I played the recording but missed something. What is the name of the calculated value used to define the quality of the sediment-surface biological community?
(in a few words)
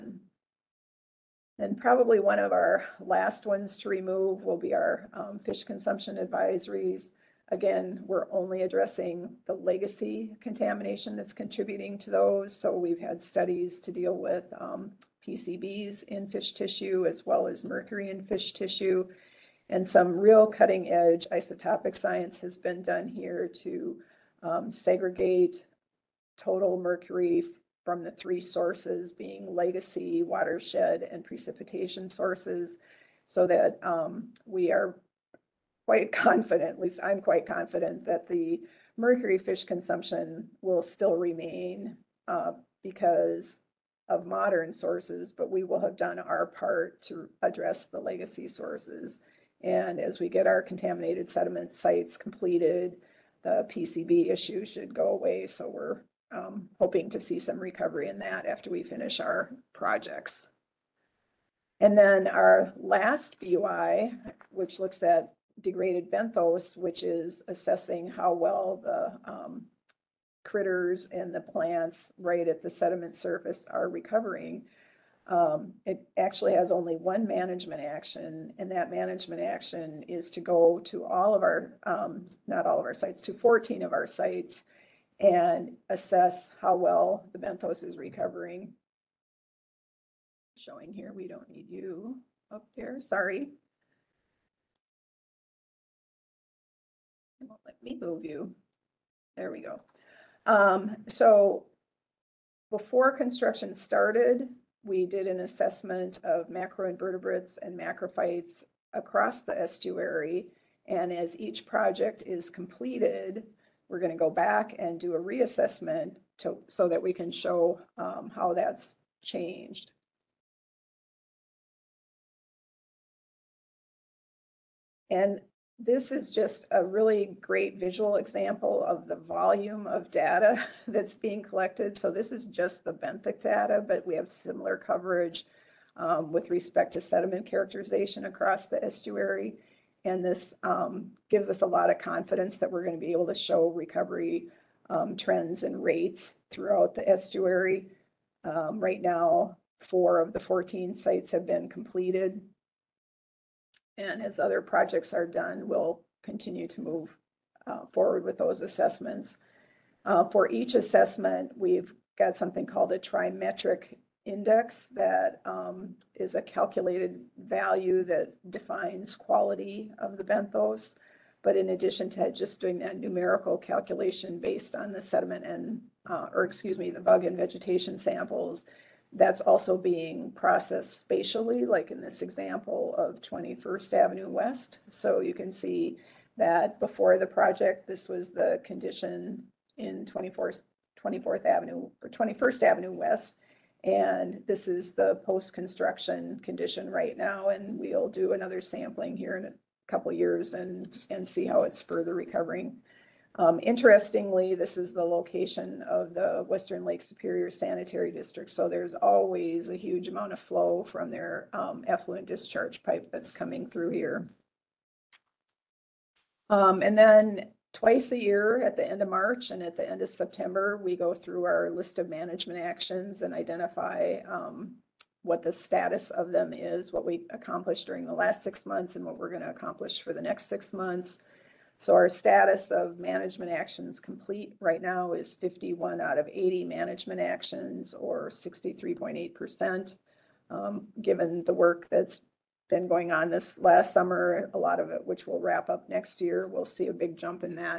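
Trimetric index.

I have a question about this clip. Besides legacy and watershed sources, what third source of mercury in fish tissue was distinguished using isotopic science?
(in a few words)
Precipitation.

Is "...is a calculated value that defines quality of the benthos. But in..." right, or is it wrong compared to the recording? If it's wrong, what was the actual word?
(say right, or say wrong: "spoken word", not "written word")
right.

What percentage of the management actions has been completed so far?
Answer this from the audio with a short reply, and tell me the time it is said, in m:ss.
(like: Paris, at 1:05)
63.8%, at 3:58.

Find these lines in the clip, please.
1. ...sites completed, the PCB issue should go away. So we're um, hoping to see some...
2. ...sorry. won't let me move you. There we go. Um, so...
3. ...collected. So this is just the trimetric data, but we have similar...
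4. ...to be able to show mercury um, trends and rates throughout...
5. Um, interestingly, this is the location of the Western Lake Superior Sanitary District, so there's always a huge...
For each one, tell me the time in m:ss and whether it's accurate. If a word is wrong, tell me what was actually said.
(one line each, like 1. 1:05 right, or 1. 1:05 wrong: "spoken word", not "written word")
1. 0:51 right
2. 1:33 right
3. 2:11 wrong: "benthic", not "trimetric"
4. 2:22 wrong: "recovery", not "mercury"
5. 3:23 right.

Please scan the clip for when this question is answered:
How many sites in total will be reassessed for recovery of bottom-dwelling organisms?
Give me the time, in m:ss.
1:23.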